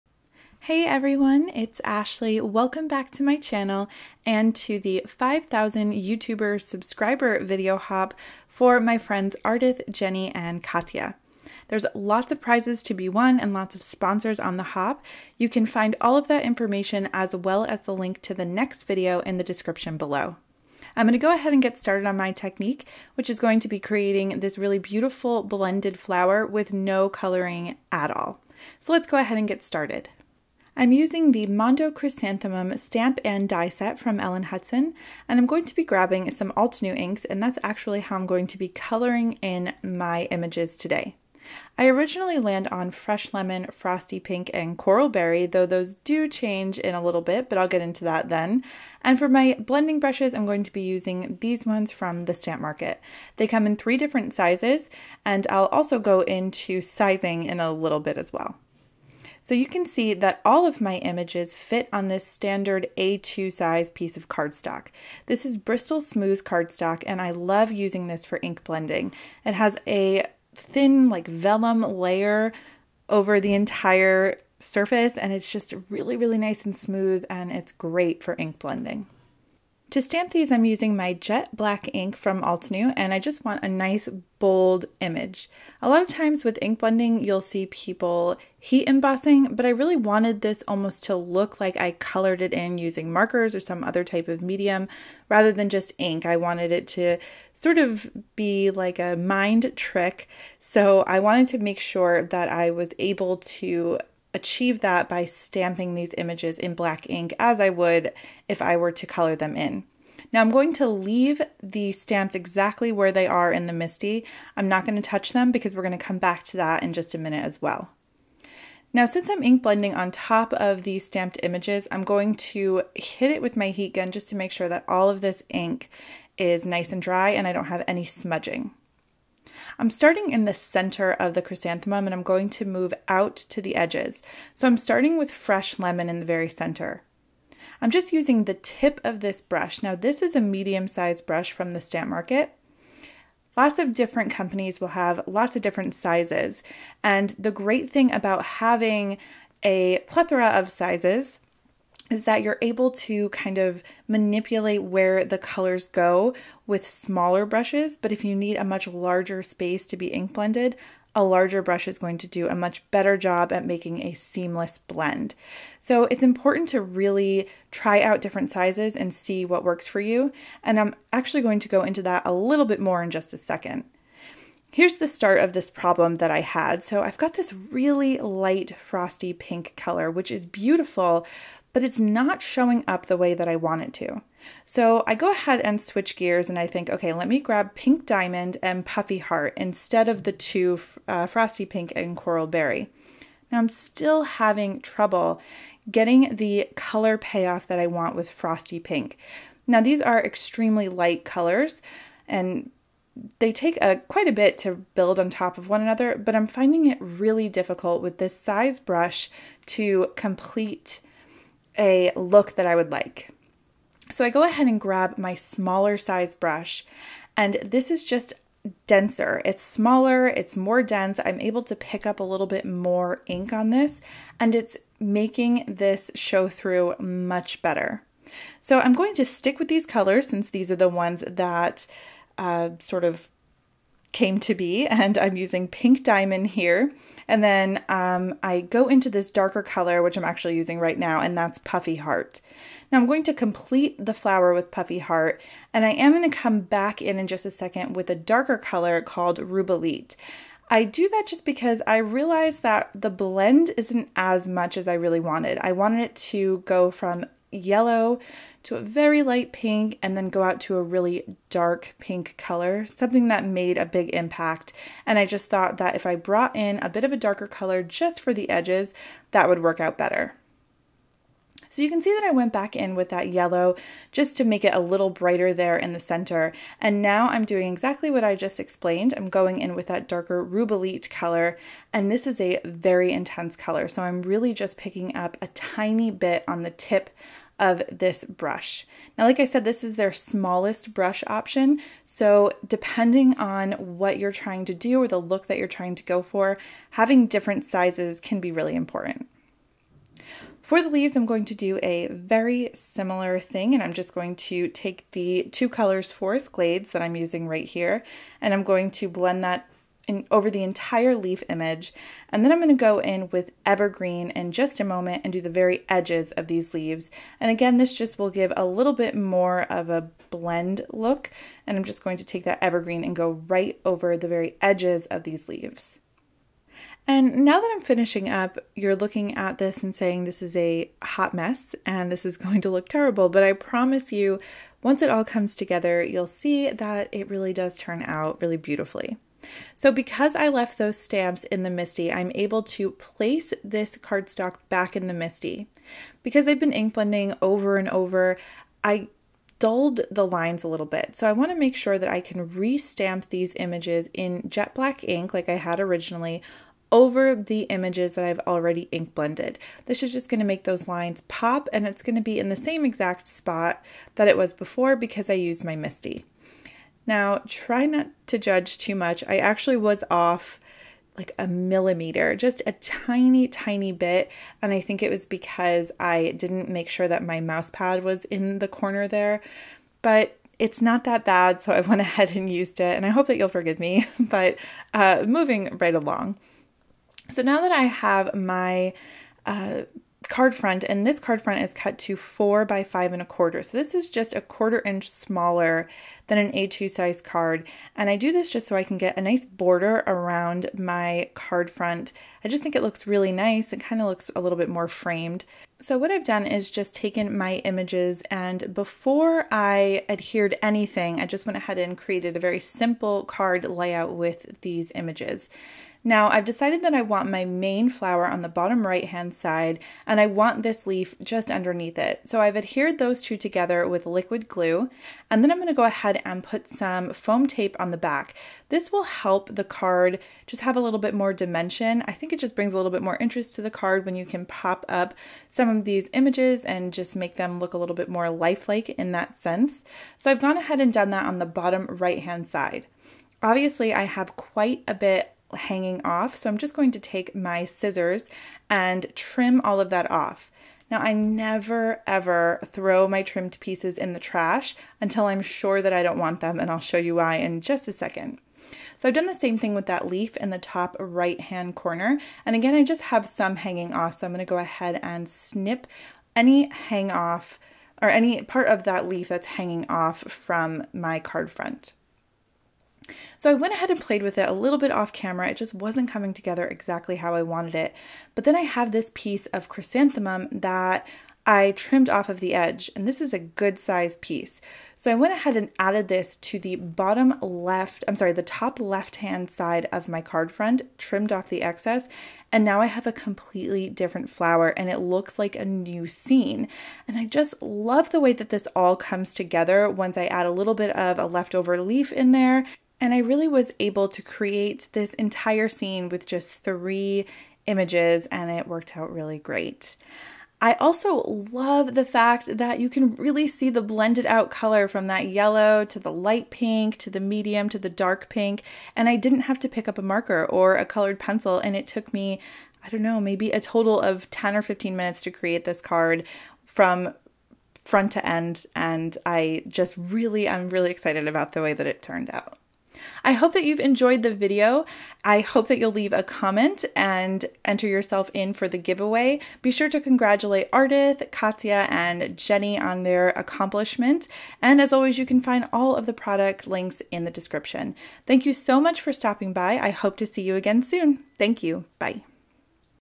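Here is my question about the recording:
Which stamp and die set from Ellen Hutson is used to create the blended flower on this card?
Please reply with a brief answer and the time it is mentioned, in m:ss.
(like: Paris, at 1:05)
Mondo Chrysanthemum, at 0:31.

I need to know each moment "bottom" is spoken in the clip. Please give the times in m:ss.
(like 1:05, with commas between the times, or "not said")
6:58, 7:21, 8:06.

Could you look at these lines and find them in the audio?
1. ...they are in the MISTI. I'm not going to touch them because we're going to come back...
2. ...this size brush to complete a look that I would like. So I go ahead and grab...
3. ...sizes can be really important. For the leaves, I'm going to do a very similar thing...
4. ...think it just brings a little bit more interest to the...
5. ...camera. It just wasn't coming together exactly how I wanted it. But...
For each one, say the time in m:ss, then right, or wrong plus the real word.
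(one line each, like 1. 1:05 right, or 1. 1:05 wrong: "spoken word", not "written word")
1. 1:53 right
2. 3:28 right
3. 4:57 right
4. 7:12 right
5. 7:55 right.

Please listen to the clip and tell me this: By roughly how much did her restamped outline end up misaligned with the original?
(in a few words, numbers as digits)
a millimeter.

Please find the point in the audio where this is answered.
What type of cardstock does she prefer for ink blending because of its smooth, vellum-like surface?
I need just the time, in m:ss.
1:05.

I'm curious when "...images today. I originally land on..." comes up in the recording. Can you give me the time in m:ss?
0:40.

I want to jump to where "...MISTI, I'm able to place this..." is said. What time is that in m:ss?
5:41.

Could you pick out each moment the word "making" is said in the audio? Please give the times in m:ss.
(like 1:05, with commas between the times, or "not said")
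2:43, 3:44.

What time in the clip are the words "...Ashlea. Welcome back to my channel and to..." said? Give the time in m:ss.
0:01.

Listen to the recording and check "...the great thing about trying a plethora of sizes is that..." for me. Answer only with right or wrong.
wrong.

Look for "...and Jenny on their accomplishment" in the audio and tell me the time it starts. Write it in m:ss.
9:01.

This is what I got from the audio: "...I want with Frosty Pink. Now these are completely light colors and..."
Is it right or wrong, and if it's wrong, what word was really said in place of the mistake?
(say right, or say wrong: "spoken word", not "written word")
wrong: "extremely", not "completely".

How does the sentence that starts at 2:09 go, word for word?
I'm starting in the center of the chrysanthemum and I'm going to move out to the edges.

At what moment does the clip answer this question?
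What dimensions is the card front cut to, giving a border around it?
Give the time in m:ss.
6:32.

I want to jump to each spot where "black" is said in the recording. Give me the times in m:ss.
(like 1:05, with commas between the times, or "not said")
1:21, 1:46, 5:54.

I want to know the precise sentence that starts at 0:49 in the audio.
And for my blending brushes, I'm going to be using these ones from the Stamp Market.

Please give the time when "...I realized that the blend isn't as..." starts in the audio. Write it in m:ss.
4:11.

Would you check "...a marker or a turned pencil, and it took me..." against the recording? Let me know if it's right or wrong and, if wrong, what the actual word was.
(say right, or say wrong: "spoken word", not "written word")
wrong: "colored", not "turned".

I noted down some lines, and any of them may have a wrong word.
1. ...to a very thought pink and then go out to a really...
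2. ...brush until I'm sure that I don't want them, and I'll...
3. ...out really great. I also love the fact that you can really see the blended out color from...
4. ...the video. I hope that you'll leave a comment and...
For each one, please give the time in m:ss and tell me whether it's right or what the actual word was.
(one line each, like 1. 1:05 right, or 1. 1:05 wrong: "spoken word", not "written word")
1. 4:18 wrong: "light", not "thought"
2. 7:34 wrong: "trash", not "brush"
3. 8:28 right
4. 8:54 right.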